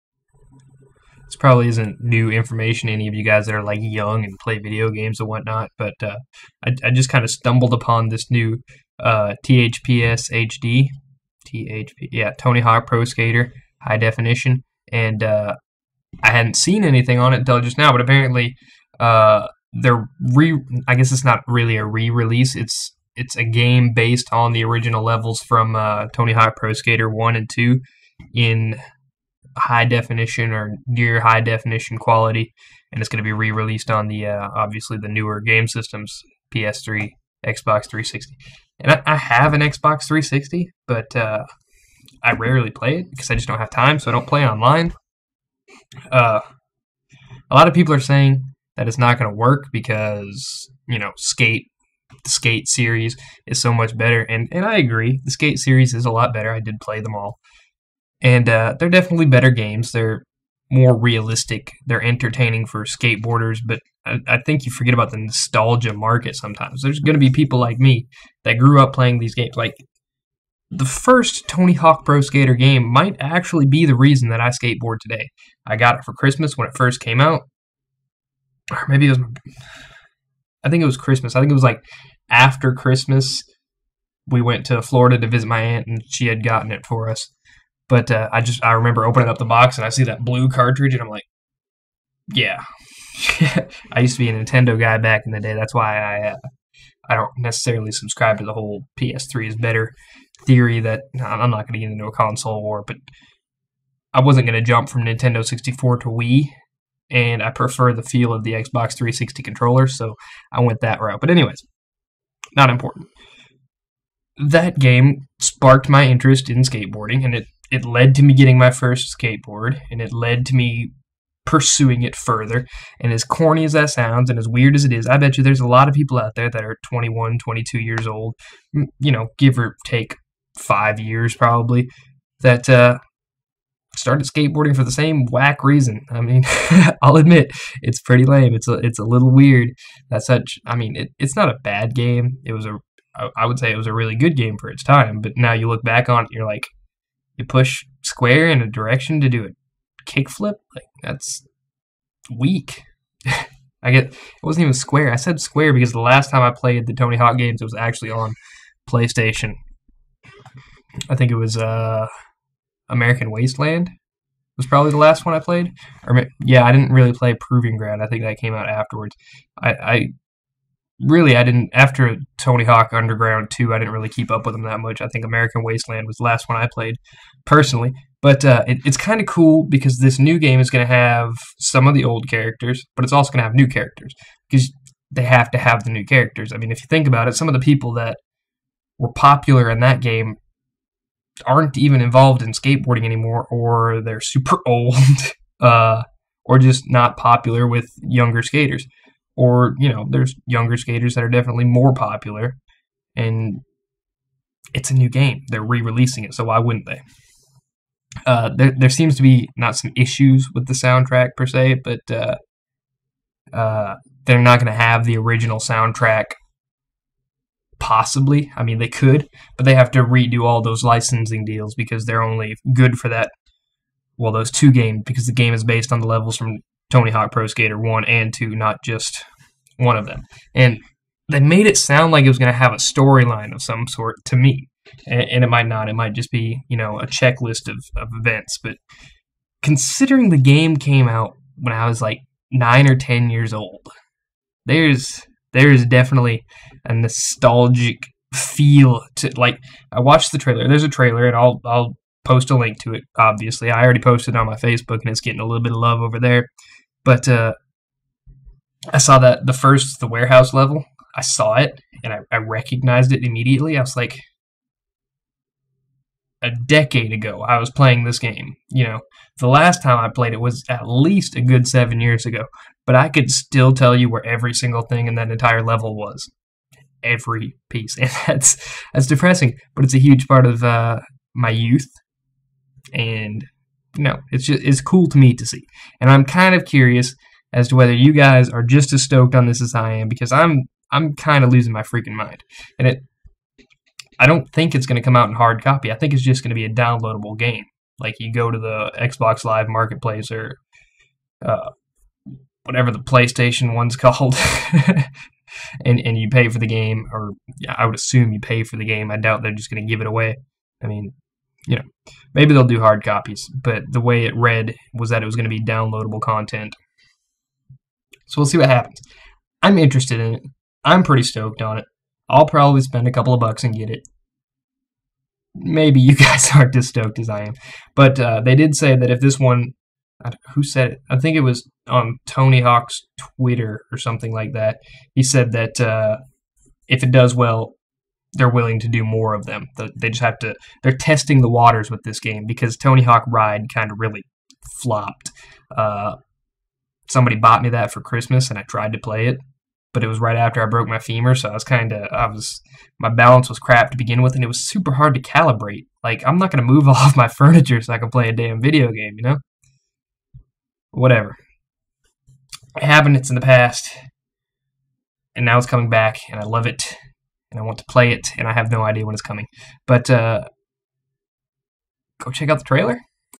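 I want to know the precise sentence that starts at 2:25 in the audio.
But now you look back on it, you're like, you push square in a direction to do a kickflip.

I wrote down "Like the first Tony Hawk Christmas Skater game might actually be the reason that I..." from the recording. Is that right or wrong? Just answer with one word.
wrong.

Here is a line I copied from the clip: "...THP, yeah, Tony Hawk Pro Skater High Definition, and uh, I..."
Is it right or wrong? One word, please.
right.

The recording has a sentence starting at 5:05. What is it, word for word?
and, and you pay for the game, or yeah, I would assume you pay for the game.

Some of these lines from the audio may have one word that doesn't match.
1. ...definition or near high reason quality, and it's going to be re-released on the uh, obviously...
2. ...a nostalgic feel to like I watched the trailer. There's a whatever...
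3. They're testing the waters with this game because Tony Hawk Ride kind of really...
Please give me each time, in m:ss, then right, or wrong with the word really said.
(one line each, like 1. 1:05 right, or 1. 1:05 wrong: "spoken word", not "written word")
1. 0:29 wrong: "definition", not "reason"
2. 4:06 wrong: "trailer", not "whatever"
3. 5:40 right.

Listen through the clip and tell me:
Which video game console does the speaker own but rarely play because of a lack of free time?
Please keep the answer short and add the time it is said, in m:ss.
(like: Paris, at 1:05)
Xbox 360, at 0:39.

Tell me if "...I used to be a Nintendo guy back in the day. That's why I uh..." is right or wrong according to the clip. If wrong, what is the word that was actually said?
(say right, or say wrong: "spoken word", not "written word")
right.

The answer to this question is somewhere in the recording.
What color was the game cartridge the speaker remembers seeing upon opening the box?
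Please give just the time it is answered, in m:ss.
1:30.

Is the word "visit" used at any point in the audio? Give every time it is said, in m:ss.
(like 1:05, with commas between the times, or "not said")
1:25.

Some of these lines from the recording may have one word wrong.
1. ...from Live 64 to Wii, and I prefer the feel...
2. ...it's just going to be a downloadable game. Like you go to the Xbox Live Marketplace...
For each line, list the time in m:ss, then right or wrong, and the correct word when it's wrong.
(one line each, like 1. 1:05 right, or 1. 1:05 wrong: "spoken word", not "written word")
1. 1:44 wrong: "Nintendo", not "Live"
2. 4:56 right.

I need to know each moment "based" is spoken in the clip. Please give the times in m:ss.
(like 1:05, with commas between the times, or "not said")
0:23, 3:45.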